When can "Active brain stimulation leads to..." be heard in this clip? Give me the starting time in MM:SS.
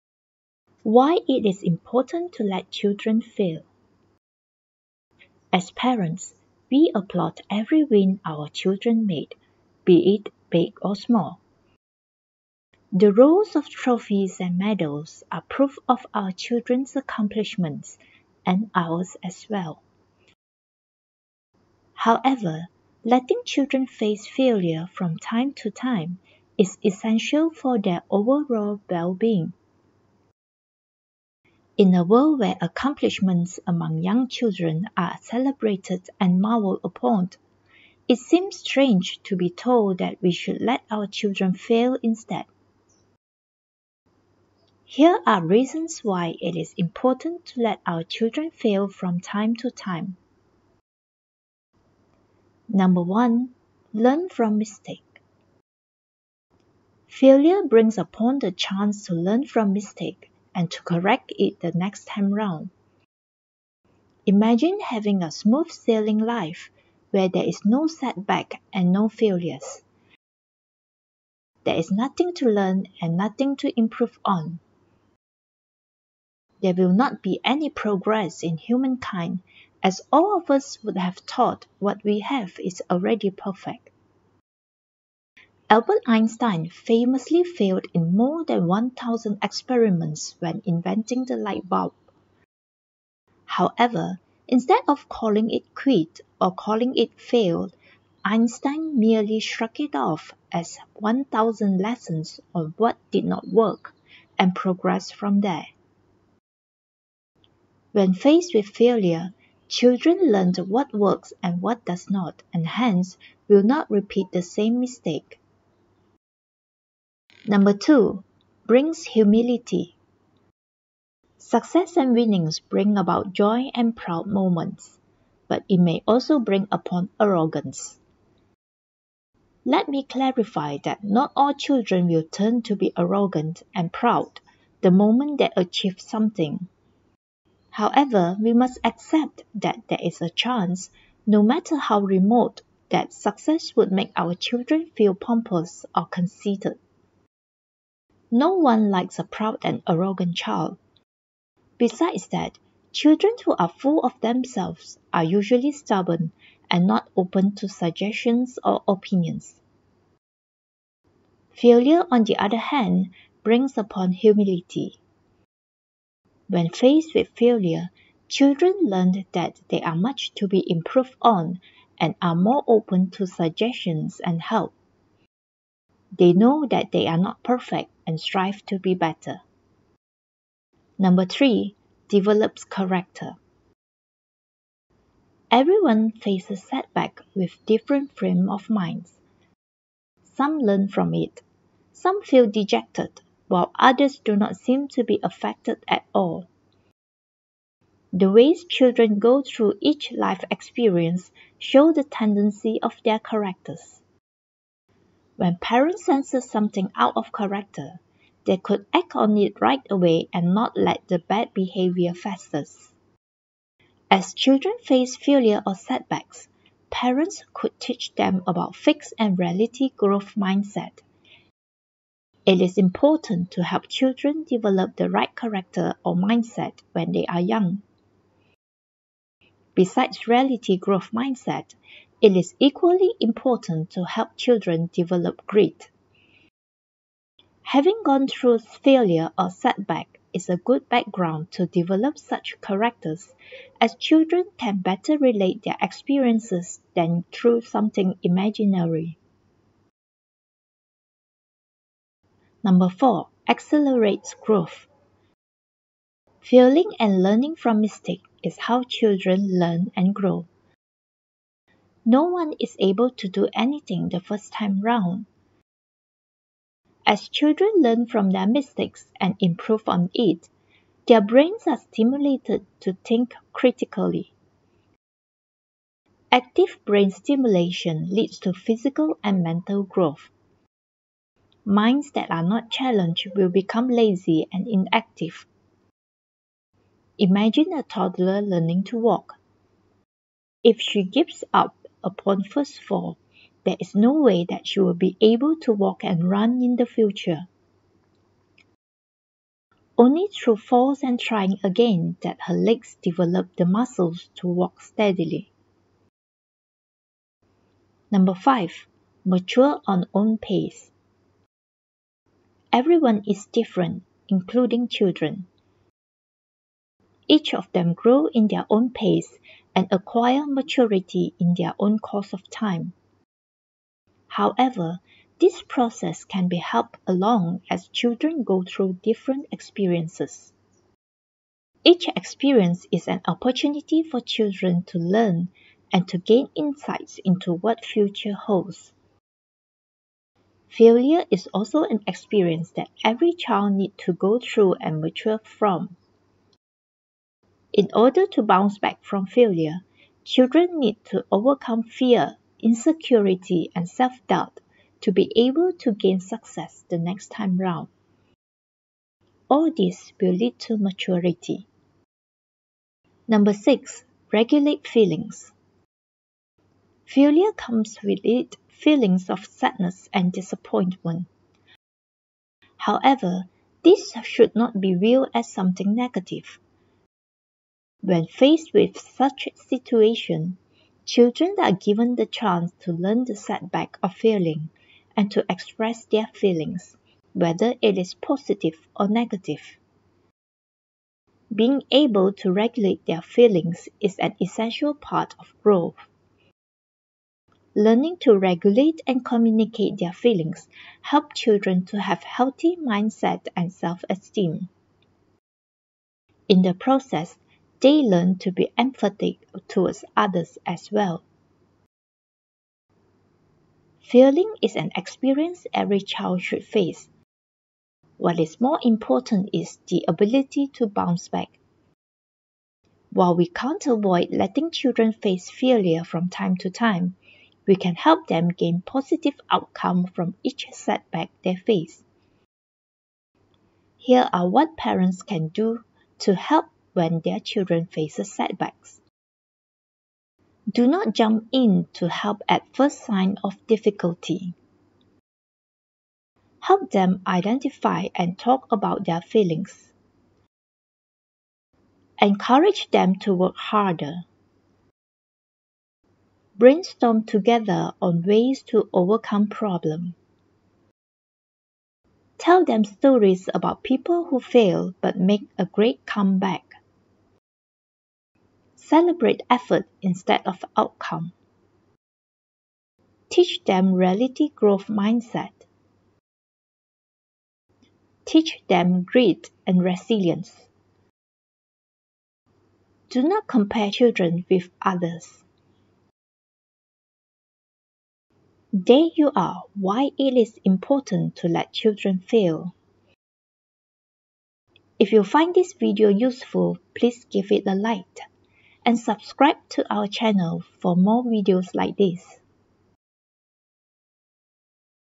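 04:36.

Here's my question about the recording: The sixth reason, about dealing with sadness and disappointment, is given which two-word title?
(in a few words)
Regulate feelings.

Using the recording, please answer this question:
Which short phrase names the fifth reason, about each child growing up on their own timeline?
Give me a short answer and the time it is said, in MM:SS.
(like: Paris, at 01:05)
Mature on own pace, at 05:09.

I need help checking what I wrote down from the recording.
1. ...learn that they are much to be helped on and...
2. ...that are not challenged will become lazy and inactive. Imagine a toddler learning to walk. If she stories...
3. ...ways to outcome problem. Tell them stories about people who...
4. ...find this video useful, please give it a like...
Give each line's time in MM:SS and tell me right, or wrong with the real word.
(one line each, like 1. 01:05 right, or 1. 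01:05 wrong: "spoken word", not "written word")
1. 02:48 wrong: "improved", not "helped"
2. 04:42 wrong: "gives", not "stories"
3. 07:38 wrong: "overcome", not "outcome"
4. 08:15 right.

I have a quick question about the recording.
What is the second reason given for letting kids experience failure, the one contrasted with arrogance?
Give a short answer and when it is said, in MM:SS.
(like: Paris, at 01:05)
Brings humility, at 01:58.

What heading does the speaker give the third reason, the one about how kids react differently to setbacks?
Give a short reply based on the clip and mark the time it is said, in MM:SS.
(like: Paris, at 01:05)
Develops character, at 03:02.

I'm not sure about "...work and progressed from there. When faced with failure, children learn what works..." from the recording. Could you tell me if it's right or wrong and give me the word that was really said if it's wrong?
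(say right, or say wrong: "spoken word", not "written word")
right.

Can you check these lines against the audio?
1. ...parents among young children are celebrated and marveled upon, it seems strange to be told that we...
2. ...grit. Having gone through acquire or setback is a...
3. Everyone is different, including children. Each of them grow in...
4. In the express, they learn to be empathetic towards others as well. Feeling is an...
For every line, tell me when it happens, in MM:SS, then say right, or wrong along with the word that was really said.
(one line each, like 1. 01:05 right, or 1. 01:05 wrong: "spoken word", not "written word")
1. 00:32 wrong: "accomplishments", not "parents"
2. 03:55 wrong: "failure", not "acquire"
3. 05:12 right
4. 06:46 wrong: "process", not "express".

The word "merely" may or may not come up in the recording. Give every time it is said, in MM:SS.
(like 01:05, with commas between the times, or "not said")
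01:38.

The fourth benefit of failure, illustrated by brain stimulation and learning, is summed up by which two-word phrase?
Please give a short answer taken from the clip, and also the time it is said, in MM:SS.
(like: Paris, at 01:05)
Accelerates growth, at 04:13.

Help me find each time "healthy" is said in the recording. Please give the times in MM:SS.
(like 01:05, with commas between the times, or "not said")
06:42.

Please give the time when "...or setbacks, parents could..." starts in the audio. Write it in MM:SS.
03:35.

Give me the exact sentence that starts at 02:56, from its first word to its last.
They know that they are not perfect and strive to be better.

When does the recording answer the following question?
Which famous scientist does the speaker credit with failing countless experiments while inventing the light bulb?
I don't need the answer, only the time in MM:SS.
01:25.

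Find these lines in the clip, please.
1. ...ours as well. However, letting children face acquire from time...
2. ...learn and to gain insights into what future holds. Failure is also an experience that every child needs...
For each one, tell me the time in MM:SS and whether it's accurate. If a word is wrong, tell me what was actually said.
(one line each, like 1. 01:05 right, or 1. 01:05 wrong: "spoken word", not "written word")
1. 00:18 wrong: "failure", not "acquire"
2. 05:34 right.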